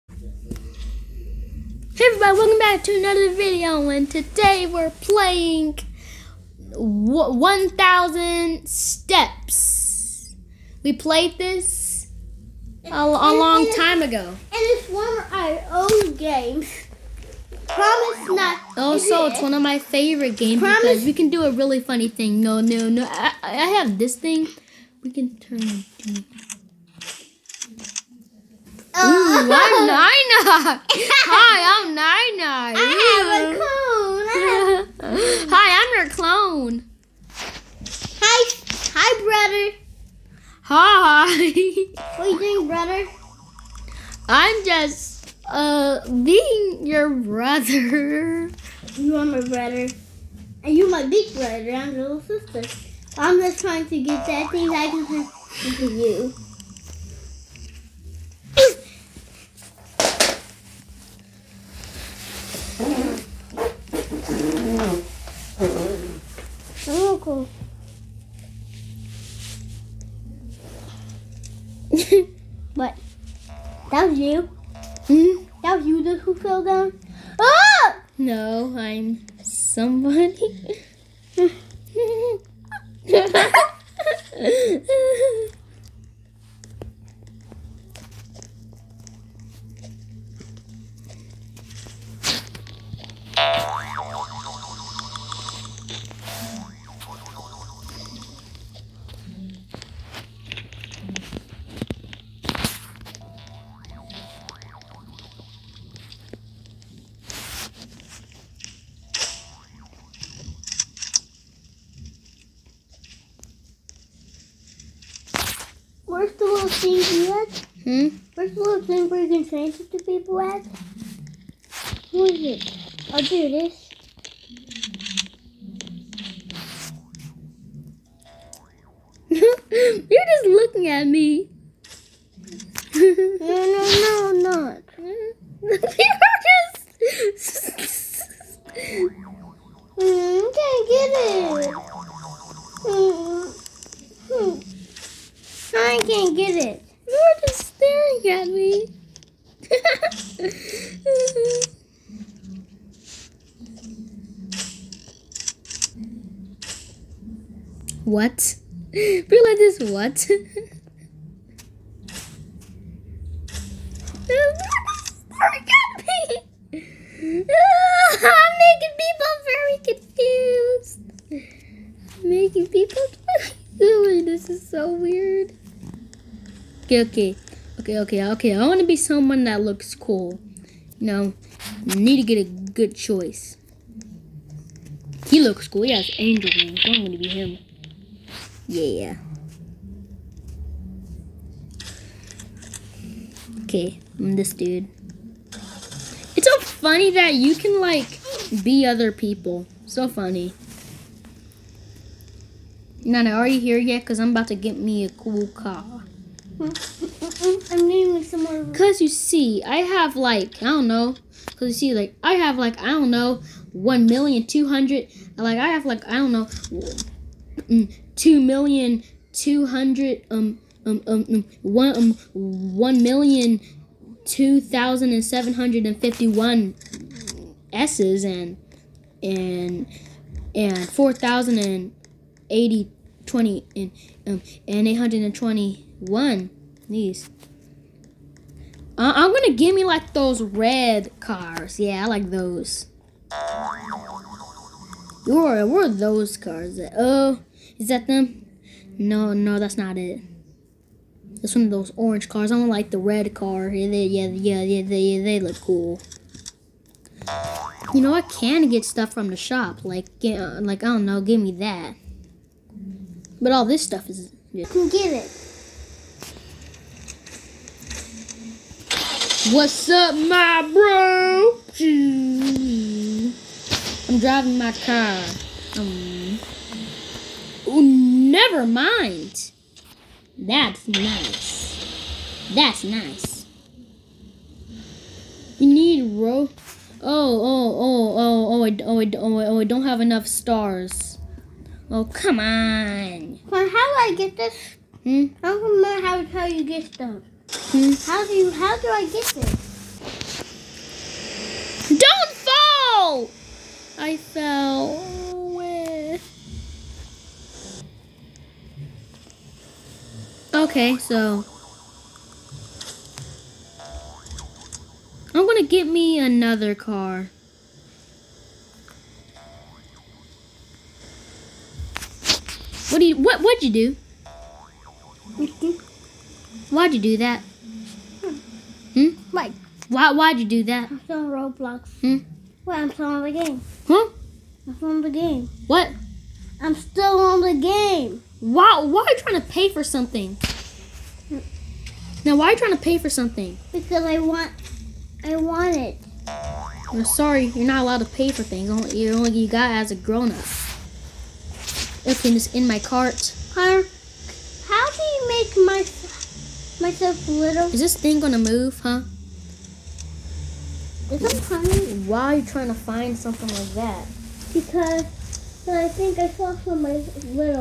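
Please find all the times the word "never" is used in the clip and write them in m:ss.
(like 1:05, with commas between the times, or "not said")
4:37.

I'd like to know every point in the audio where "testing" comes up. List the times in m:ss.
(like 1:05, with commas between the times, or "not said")
not said.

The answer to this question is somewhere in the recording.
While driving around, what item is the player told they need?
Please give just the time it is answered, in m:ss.
4:46.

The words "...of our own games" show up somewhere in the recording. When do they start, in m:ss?
0:15.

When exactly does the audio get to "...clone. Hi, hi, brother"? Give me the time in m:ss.
0:36.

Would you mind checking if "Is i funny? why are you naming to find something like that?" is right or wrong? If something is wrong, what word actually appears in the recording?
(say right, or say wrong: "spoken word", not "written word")
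wrong: "trying", not "naming".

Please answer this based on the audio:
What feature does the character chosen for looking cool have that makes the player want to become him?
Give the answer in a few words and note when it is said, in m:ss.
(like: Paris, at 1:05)
Angel wings, at 3:06.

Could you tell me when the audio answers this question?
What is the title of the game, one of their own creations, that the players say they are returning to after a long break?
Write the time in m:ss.
0:06.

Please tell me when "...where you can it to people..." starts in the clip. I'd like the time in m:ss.
1:59.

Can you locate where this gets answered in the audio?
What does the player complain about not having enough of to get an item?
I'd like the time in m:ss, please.
4:50.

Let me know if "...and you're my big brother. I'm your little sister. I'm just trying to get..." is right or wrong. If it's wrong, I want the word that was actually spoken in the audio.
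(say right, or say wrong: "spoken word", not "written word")
right.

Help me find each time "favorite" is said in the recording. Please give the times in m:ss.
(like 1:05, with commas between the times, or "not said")
0:19.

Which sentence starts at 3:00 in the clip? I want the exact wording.
You know, need to get a good choice.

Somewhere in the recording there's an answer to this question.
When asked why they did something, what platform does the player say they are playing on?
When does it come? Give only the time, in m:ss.
5:31.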